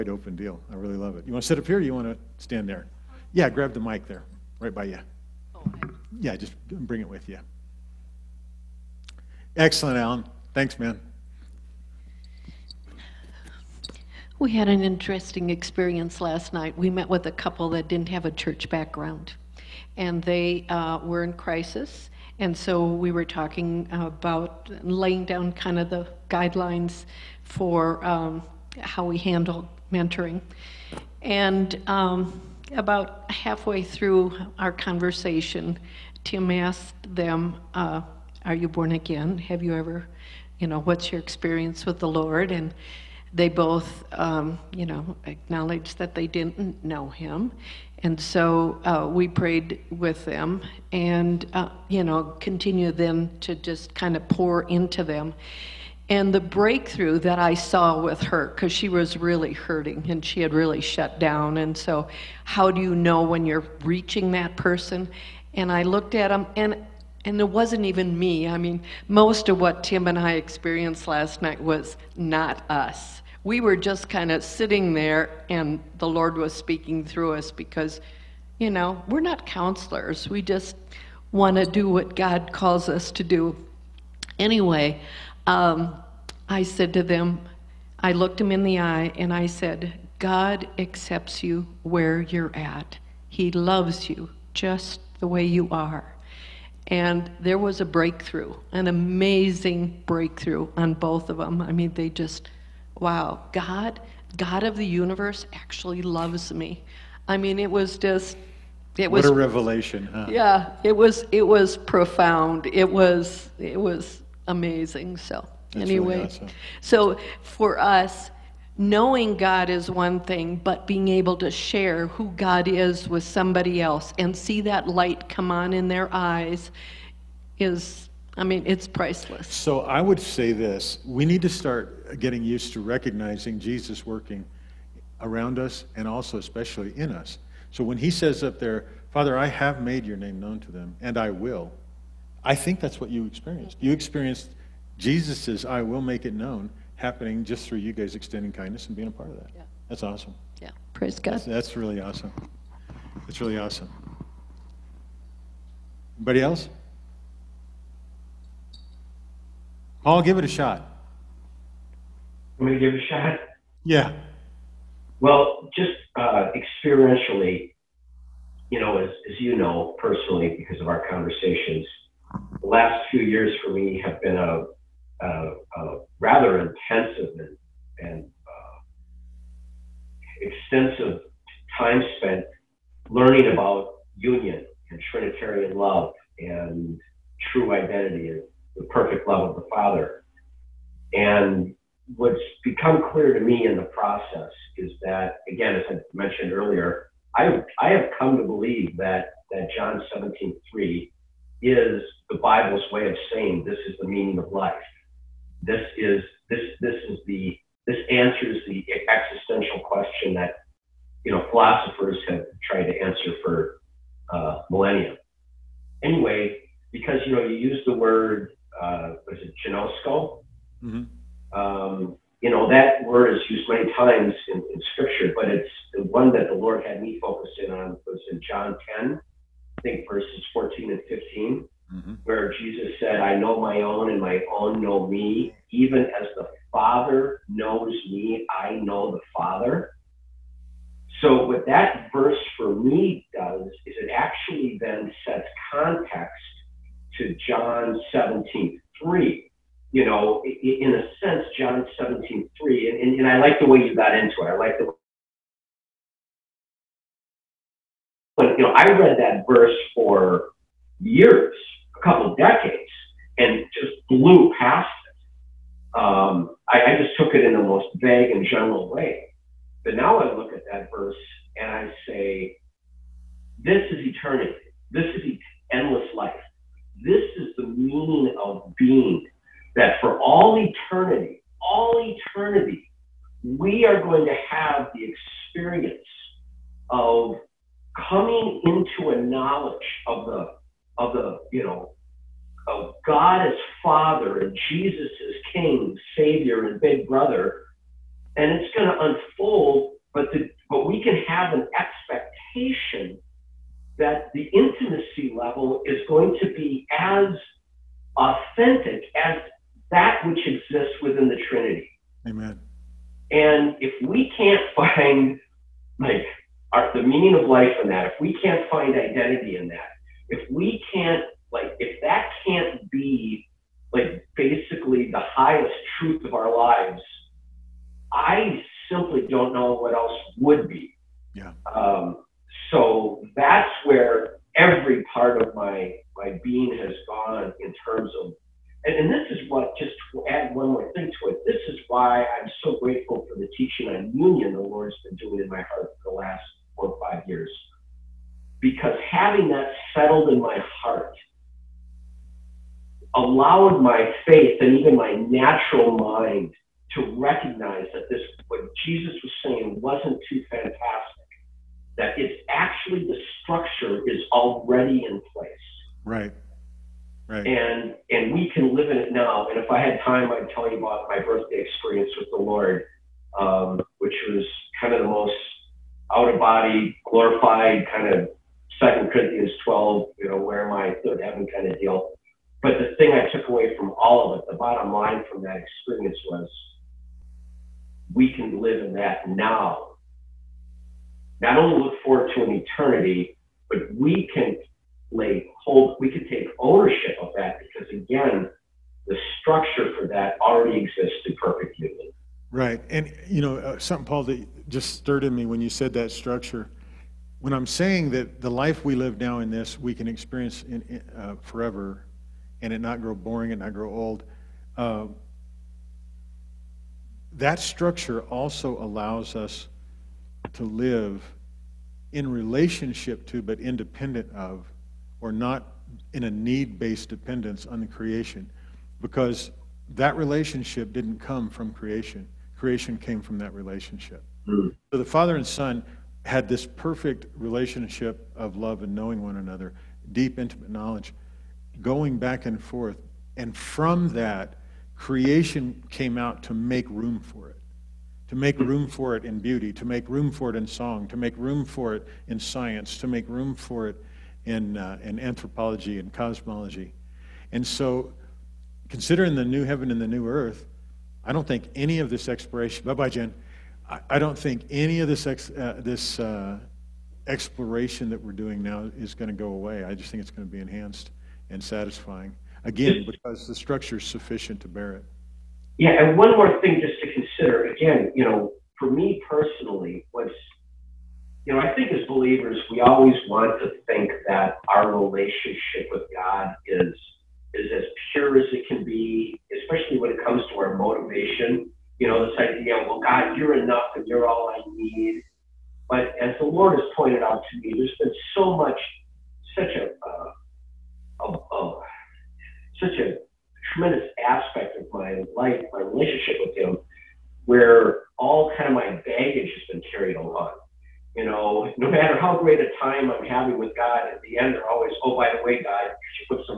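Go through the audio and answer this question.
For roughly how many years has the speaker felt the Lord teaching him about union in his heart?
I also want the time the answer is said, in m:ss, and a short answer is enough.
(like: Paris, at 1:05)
4 or 5, at 5:46.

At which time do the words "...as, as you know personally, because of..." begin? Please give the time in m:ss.
2:48.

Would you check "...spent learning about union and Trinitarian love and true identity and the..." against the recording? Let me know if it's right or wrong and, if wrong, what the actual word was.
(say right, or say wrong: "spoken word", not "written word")
right.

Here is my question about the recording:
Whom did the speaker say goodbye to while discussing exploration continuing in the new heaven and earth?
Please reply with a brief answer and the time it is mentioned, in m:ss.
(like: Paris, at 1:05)
Jen, at 7:43.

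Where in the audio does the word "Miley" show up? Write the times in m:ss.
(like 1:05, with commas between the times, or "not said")
not said.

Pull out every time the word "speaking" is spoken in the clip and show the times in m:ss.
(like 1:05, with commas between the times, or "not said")
1:16.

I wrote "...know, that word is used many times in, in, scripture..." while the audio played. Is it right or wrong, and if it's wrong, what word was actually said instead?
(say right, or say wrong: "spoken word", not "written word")
right.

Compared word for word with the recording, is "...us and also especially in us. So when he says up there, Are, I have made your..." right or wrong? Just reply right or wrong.
wrong.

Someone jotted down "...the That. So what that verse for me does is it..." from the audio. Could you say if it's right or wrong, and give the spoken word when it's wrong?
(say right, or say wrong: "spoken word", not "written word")
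wrong: "Father", not "That".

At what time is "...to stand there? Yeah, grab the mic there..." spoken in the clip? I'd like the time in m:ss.
0:02.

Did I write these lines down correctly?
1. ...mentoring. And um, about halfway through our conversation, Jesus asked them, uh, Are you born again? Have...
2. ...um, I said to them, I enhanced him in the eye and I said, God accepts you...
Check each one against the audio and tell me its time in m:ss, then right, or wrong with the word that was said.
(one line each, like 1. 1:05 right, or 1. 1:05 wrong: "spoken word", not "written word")
1. 0:29 wrong: "Tim", not "Jesus"
2. 1:25 wrong: "looked", not "enhanced".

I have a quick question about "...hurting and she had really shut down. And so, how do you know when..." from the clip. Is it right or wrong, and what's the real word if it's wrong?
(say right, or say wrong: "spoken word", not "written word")
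right.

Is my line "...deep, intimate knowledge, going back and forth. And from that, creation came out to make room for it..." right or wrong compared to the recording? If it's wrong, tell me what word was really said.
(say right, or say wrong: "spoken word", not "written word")
right.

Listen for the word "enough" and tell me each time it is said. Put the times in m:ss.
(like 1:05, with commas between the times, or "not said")
8:13.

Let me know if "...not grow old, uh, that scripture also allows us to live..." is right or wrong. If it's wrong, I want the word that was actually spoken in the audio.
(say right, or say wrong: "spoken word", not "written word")
wrong: "structure", not "scripture".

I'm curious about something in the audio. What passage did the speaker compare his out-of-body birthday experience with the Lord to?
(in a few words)
Second Corinthians 12.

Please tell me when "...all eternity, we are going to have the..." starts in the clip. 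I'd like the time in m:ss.
4:41.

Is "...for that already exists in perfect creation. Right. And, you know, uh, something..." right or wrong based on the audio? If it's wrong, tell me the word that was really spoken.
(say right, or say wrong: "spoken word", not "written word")
wrong: "union", not "creation".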